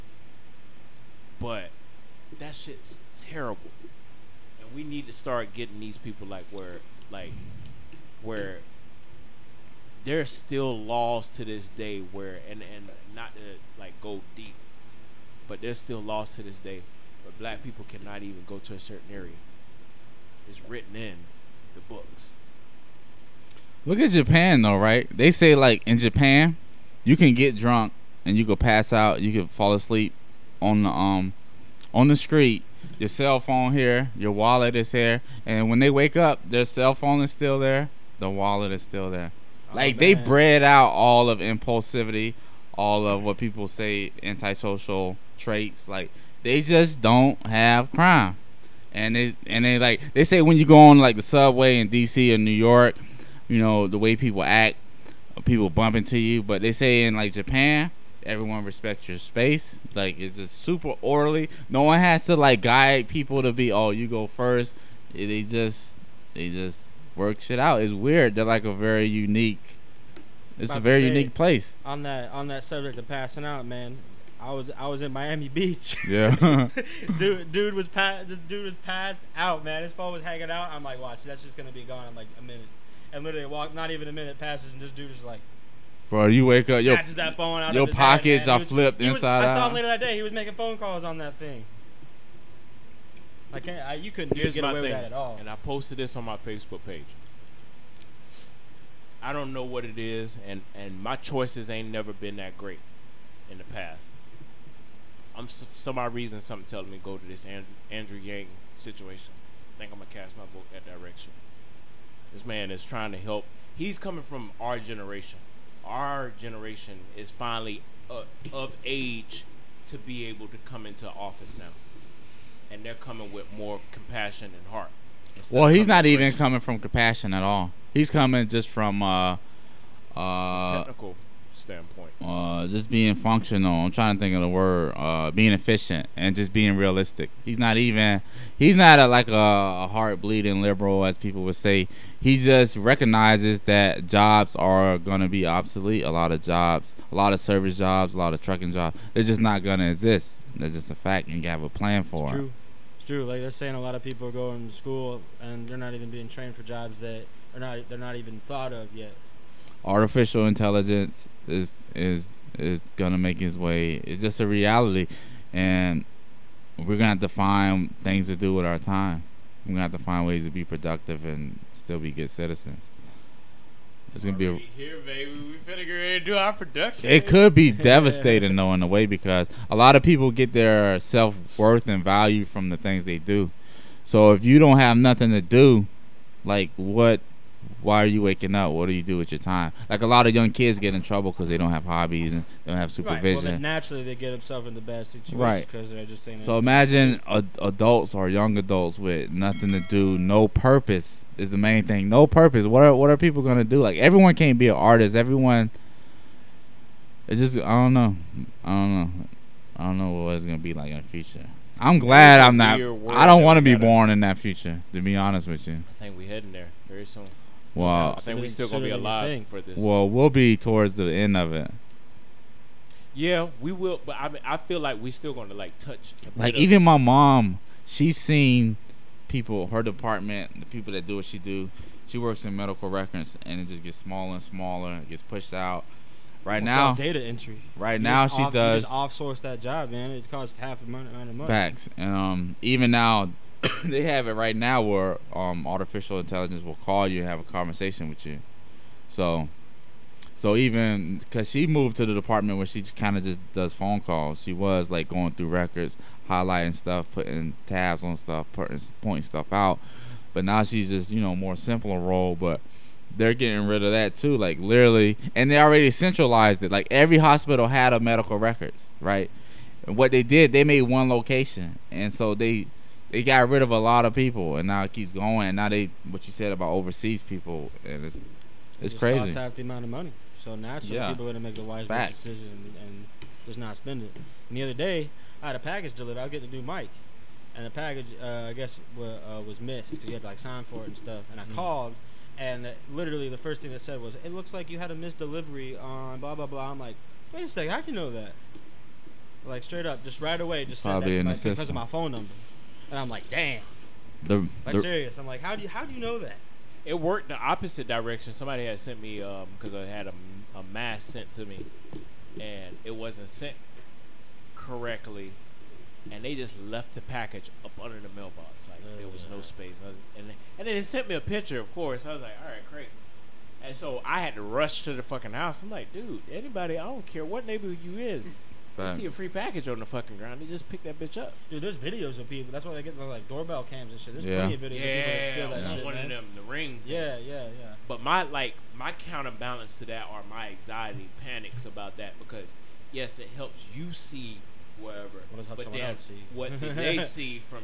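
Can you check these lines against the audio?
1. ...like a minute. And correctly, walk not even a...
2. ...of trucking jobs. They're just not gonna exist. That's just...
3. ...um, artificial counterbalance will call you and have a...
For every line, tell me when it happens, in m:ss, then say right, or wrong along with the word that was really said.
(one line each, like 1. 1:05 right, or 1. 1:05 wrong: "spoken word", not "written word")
1. 1:22 wrong: "literally", not "correctly"
2. 2:28 right
3. 4:05 wrong: "intelligence", not "counterbalance".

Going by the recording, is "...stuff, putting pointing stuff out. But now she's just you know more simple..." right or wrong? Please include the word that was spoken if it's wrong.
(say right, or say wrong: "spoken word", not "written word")
right.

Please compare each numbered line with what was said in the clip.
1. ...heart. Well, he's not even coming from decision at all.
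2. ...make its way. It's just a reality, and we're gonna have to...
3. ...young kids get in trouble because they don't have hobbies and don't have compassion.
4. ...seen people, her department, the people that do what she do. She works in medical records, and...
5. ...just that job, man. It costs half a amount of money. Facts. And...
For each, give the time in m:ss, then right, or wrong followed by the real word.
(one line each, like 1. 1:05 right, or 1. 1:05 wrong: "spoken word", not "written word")
1. 2:04 wrong: "compassion", not "decision"
2. 2:43 right
3. 3:10 wrong: "supervision", not "compassion"
4. 3:48 right
5. 3:59 right.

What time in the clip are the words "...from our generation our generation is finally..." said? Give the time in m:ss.
1:54.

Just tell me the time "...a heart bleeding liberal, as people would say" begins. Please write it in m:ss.
2:19.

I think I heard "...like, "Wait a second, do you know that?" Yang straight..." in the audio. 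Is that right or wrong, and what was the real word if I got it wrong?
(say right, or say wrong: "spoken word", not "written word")
wrong: "Like", not "Yang".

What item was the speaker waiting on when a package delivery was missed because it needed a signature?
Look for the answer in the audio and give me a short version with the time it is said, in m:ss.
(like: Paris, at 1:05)
A new mic, at 4:46.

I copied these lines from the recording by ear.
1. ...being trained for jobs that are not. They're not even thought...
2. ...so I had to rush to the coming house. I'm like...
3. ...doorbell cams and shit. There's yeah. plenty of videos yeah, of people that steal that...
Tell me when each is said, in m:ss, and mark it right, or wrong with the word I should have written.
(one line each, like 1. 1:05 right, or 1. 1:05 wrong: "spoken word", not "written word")
1. 2:36 right
2. 5:23 wrong: "fucking", not "coming"
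3. 5:33 right.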